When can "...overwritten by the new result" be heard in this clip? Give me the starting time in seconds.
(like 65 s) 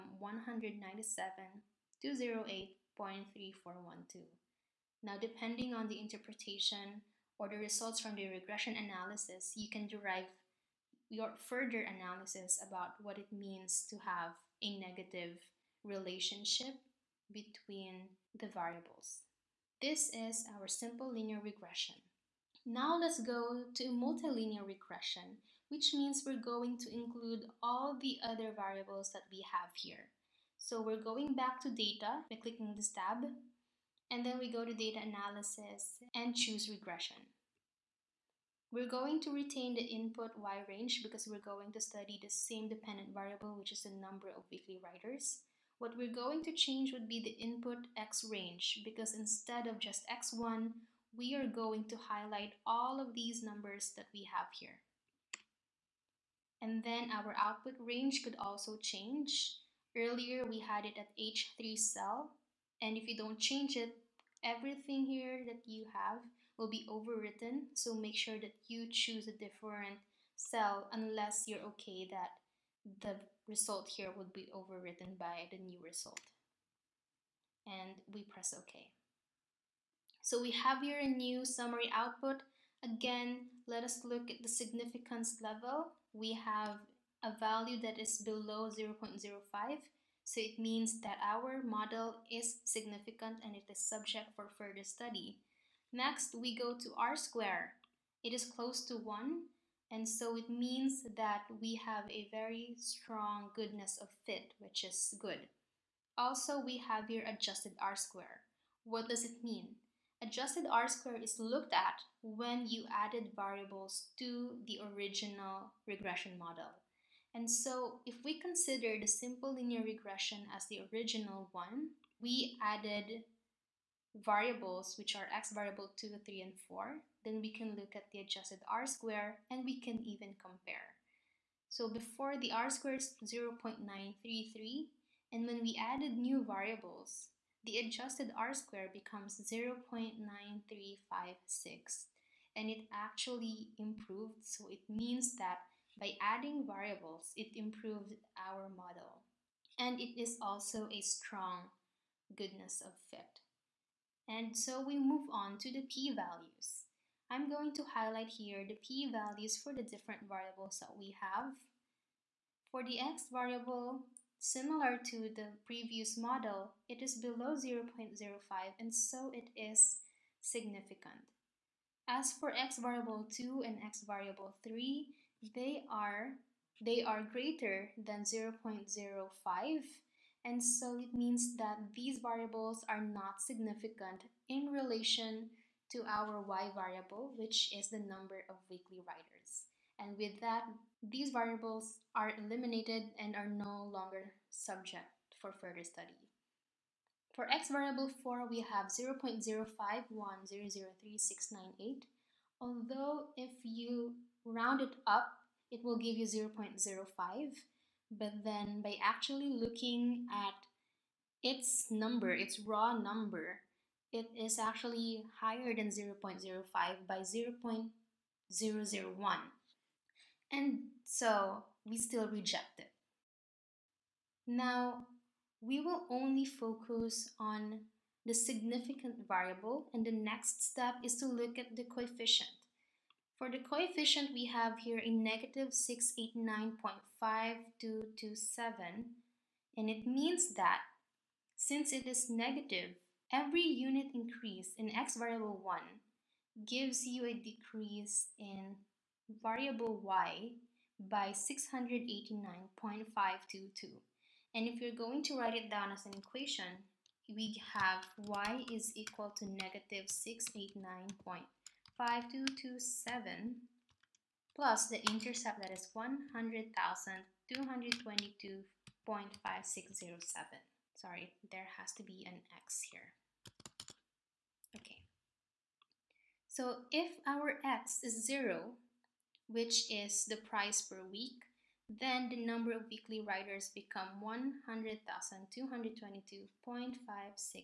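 74 s.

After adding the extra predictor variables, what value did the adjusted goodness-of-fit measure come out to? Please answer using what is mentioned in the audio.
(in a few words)
0.9356.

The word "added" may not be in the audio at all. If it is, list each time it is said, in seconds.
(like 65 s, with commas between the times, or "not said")
112 s, 122 s, 135 s.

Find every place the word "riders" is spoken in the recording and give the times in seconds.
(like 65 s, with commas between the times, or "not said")
189 s, 283 s.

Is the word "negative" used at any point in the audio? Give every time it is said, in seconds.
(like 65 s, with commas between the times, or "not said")
14 s, 235 s, 242 s, 259 s.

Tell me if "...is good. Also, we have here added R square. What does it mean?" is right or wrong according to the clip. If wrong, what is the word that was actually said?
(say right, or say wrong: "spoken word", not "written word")
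wrong: "adjusted", not "added".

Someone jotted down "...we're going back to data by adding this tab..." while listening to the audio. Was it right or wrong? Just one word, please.
wrong.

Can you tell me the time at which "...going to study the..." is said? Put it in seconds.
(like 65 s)
41 s.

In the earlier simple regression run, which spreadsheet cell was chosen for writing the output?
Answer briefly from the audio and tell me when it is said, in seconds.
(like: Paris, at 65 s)
H3, at 61 s.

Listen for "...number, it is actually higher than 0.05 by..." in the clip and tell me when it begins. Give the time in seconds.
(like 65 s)
212 s.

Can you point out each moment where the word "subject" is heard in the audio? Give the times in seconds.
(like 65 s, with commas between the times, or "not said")
93 s, 194 s.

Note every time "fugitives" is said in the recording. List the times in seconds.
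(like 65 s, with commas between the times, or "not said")
not said.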